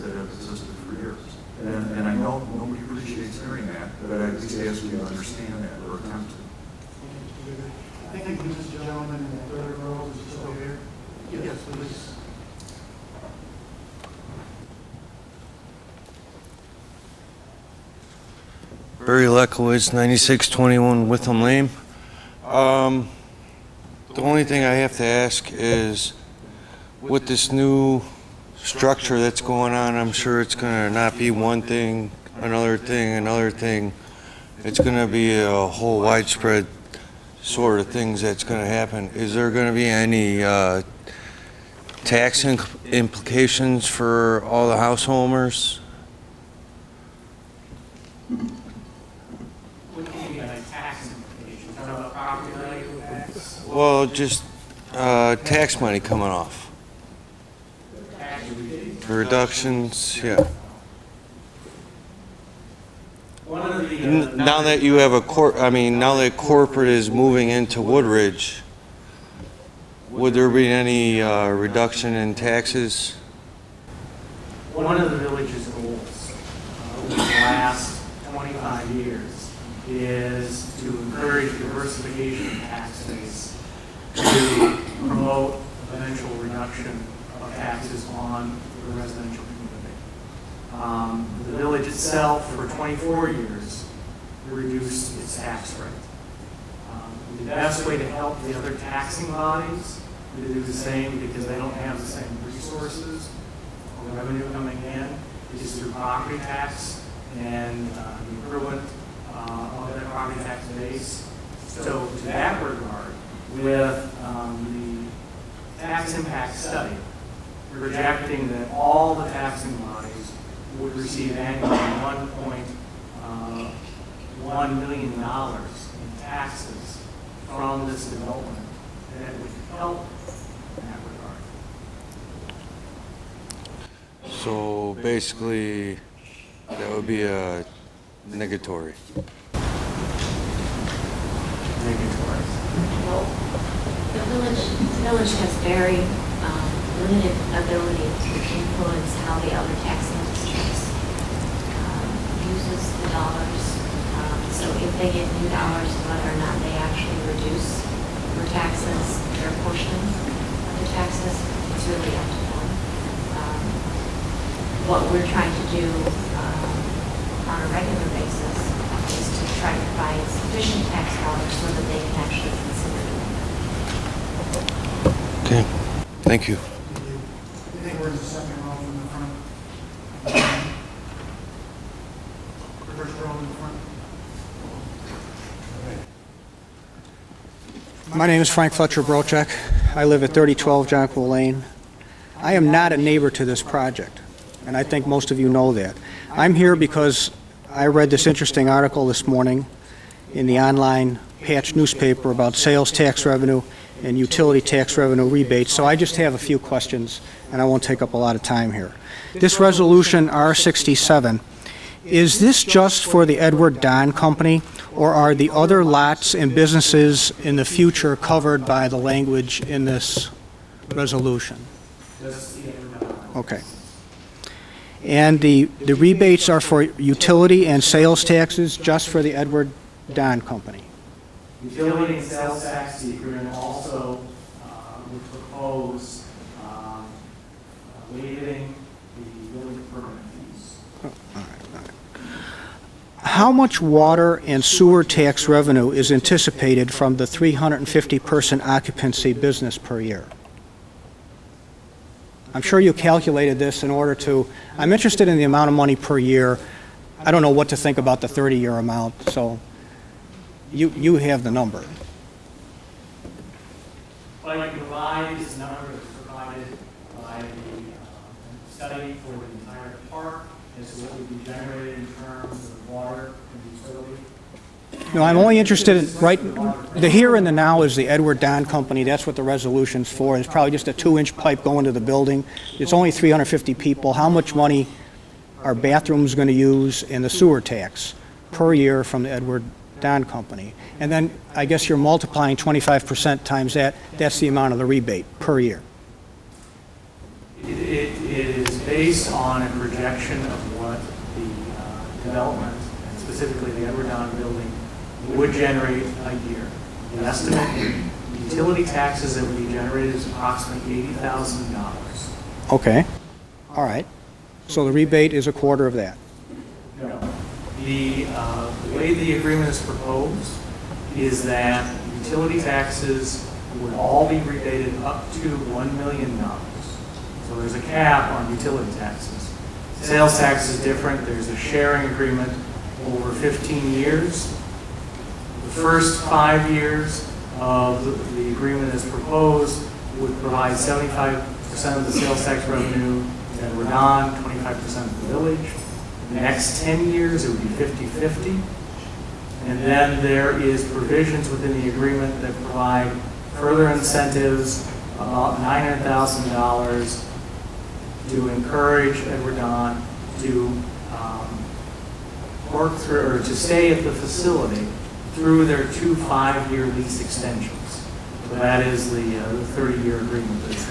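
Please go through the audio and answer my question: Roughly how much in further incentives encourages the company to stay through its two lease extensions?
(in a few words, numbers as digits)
$900,000.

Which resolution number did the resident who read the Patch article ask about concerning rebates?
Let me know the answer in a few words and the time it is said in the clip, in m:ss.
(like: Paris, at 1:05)
R67, at 3:30.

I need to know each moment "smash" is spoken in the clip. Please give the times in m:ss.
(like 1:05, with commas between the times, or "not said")
not said.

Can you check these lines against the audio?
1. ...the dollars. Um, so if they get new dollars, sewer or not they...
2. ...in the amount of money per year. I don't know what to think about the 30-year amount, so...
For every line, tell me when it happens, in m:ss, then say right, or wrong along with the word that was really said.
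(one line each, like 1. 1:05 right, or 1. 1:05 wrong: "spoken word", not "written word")
1. 2:33 wrong: "whether", not "sewer"
2. 4:15 right.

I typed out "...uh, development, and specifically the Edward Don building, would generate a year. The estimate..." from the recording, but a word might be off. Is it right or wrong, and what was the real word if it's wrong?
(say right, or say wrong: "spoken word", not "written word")
right.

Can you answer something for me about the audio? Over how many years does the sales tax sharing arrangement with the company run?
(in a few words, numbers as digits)
15 years.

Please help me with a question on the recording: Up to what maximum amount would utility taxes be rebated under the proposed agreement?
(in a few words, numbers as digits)
$1 million.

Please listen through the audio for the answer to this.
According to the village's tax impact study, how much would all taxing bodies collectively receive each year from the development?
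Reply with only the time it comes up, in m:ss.
2:01.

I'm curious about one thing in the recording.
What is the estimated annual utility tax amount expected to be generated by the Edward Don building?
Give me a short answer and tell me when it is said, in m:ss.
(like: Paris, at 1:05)
$80,000, at 5:11.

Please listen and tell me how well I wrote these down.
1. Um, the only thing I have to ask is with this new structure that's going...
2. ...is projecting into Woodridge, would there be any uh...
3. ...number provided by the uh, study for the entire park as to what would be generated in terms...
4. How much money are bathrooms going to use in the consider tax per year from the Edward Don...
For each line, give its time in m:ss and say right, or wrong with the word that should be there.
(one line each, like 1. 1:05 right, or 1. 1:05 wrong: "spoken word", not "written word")
1. 0:22 right
2. 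1:06 wrong: "moving", not "projecting"
3. 4:25 right
4. 4:44 wrong: "sewer", not "consider".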